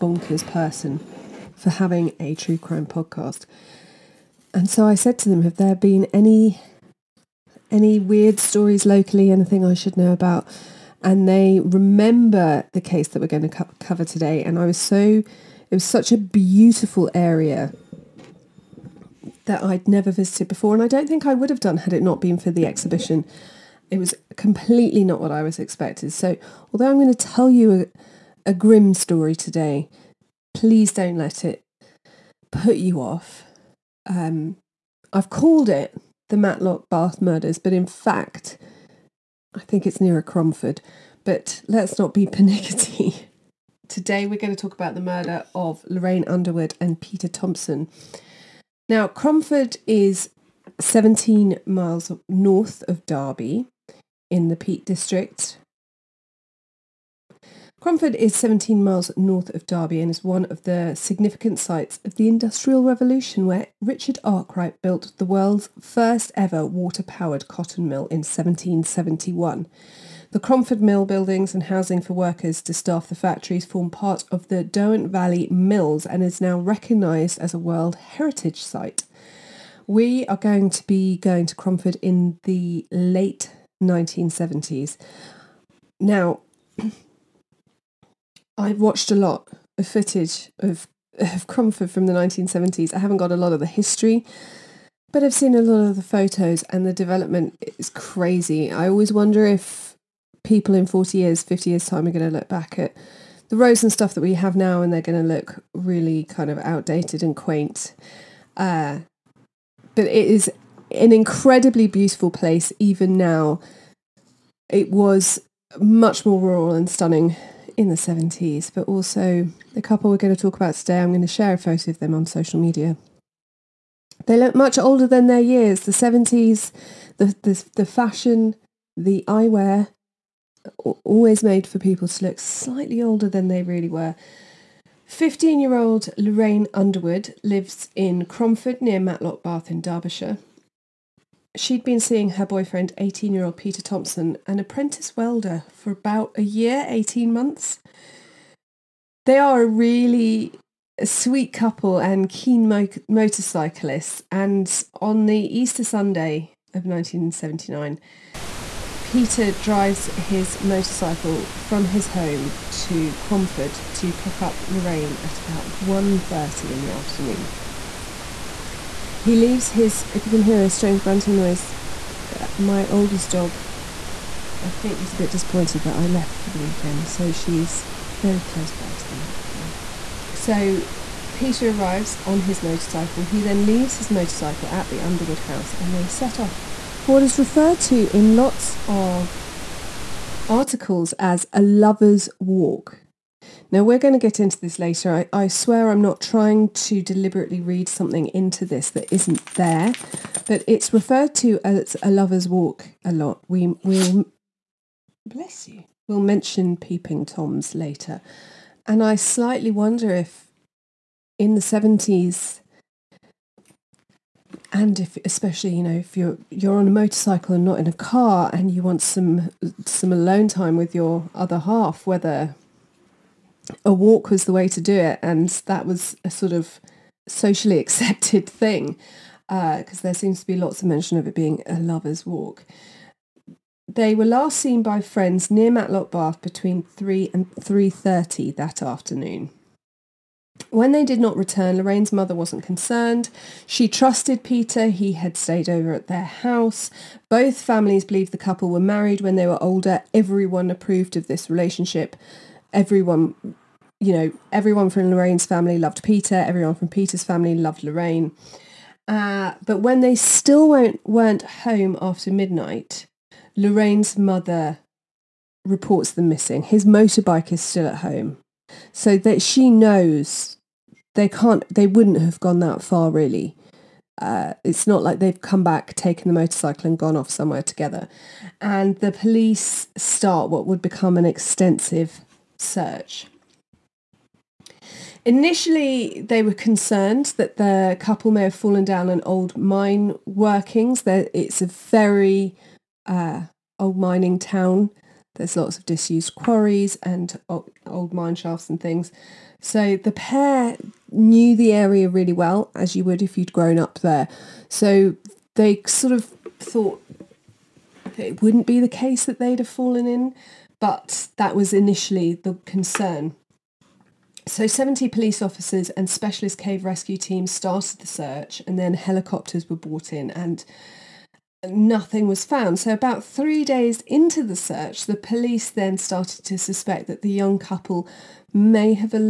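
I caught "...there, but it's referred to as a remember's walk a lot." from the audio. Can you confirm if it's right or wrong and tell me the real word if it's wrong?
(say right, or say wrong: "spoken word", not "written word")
wrong: "lover", not "remember".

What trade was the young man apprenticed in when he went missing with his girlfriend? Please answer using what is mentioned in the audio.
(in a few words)
Welder.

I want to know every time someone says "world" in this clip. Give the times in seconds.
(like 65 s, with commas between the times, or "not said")
65 s, 77 s.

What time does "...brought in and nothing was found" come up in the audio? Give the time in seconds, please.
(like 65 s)
319 s.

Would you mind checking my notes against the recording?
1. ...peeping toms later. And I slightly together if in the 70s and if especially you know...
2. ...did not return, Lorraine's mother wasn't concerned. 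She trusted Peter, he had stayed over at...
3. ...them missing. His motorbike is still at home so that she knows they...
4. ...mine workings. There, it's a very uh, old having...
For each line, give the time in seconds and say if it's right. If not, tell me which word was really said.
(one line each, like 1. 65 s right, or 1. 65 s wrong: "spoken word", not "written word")
1. 206 s wrong: "wonder", not "together"
2. 241 s right
3. 266 s right
4. 289 s wrong: "mining", not "having".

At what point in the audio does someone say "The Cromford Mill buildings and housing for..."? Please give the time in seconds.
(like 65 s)
70 s.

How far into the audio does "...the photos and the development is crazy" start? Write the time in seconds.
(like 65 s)
95 s.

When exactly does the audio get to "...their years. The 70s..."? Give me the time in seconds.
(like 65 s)
125 s.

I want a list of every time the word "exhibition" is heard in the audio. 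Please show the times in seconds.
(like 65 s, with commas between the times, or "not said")
22 s.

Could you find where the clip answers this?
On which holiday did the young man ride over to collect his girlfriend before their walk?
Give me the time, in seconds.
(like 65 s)
155 s.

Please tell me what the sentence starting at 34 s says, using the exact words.
Um, I've called it the Matlock Bath Murders, but in fact, I think it's nearer Cromford.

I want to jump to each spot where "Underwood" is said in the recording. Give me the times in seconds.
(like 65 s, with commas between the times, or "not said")
46 s, 136 s, 185 s.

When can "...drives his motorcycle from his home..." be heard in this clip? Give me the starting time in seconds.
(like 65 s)
159 s.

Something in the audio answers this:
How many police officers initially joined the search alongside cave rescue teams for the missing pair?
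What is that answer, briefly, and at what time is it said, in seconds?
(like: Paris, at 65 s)
70, at 314 s.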